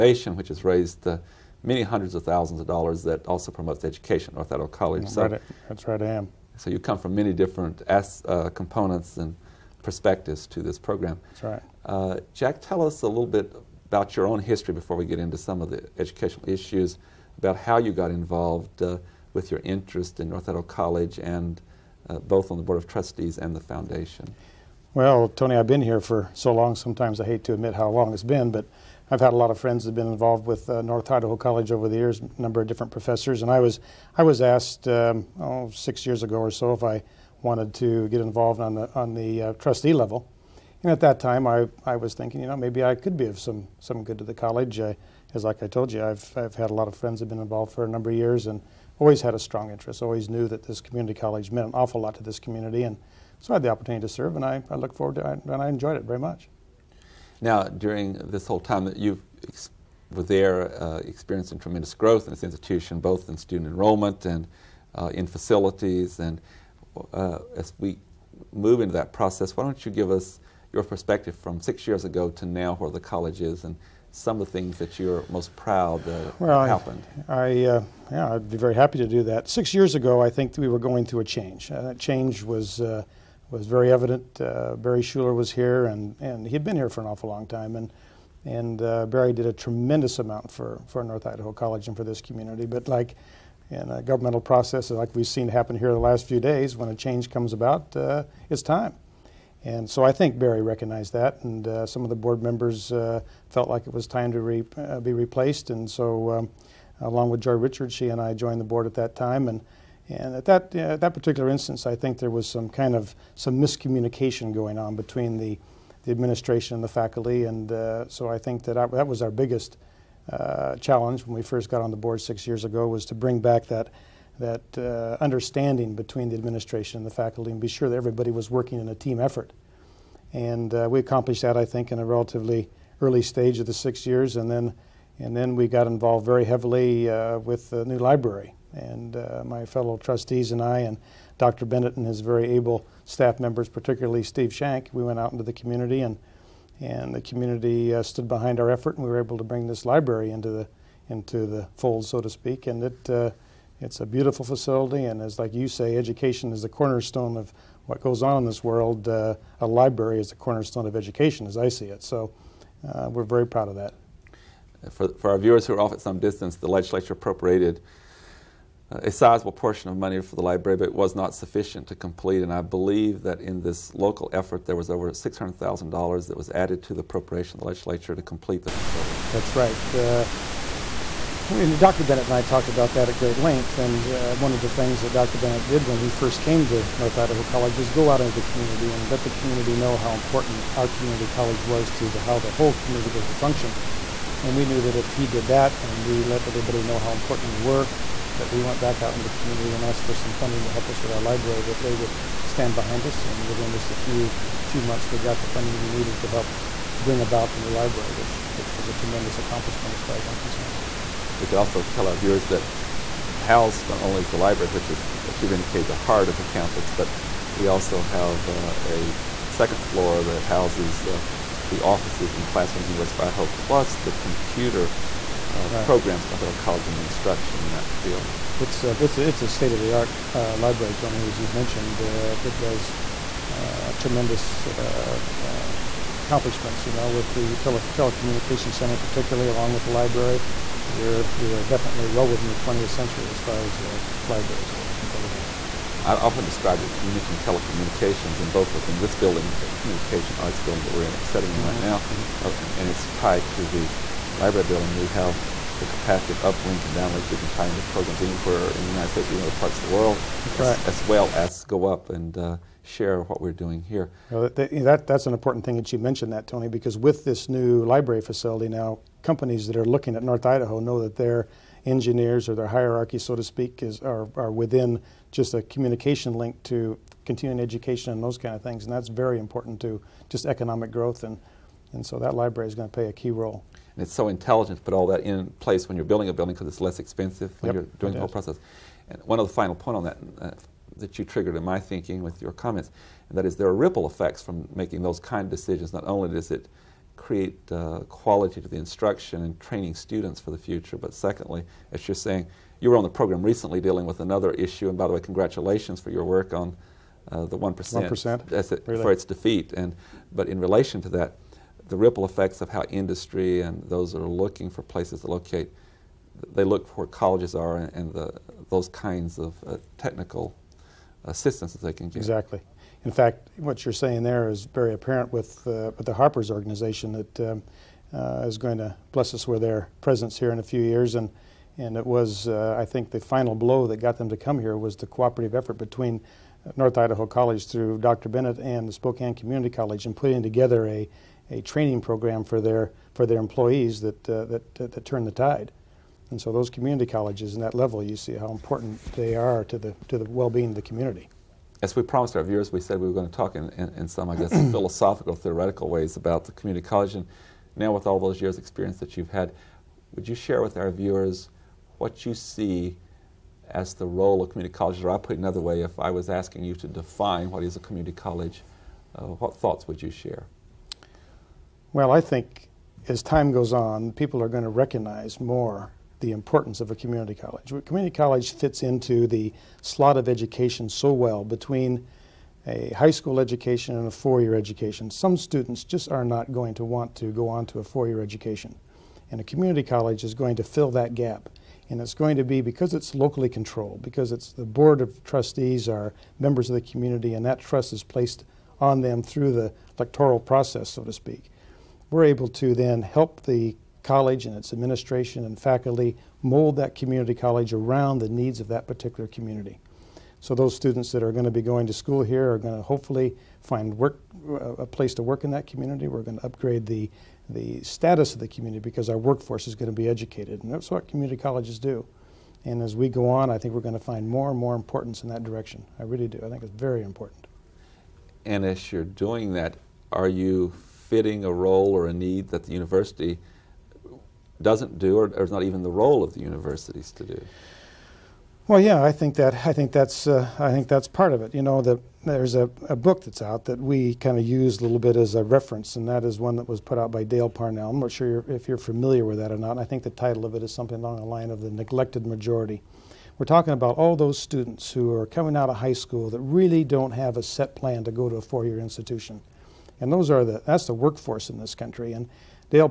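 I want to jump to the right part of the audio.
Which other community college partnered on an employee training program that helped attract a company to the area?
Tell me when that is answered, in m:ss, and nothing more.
5:38.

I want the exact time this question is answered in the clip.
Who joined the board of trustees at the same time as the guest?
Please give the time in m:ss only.
1:47.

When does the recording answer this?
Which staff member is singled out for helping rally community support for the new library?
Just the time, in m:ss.
2:24.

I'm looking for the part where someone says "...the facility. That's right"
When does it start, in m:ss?
2:58.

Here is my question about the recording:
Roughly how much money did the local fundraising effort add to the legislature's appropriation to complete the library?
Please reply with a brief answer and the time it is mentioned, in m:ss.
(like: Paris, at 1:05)
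$600,000, at 2:55.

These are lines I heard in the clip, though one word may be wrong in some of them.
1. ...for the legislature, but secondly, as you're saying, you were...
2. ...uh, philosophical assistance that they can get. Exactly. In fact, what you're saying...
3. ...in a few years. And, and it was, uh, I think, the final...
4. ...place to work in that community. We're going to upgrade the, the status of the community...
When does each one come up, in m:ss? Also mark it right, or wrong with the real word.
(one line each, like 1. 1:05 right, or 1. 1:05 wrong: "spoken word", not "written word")
1. 5:00 wrong: "future", not "legislature"
2. 5:19 wrong: "technical", not "philosophical"
3. 5:30 right
4. 6:54 right.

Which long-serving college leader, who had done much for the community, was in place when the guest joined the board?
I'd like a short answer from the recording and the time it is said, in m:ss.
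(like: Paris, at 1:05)
Barry Schuler, at 1:24.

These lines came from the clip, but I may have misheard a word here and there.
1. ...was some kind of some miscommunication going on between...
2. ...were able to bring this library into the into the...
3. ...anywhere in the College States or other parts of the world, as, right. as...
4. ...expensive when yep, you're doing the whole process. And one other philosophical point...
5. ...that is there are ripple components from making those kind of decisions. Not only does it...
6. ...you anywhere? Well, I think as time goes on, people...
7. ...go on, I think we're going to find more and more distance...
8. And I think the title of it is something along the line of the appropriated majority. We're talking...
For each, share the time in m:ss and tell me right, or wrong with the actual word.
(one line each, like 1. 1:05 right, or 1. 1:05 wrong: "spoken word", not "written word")
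1. 1:52 right
2. 2:29 right
3. 4:18 wrong: "United", not "College"
4. 4:46 wrong: "final", not "philosophical"
5. 4:53 wrong: "effects", not "components"
6. 6:10 wrong: "share", not "anywhere"
7. 7:03 wrong: "importance", not "distance"
8. 7:29 wrong: "neglected", not "appropriated".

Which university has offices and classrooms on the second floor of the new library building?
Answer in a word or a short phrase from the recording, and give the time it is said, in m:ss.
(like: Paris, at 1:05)
University of Idaho, at 3:42.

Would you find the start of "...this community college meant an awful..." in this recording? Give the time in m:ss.
0:50.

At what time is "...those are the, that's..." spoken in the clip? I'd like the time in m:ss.
7:40.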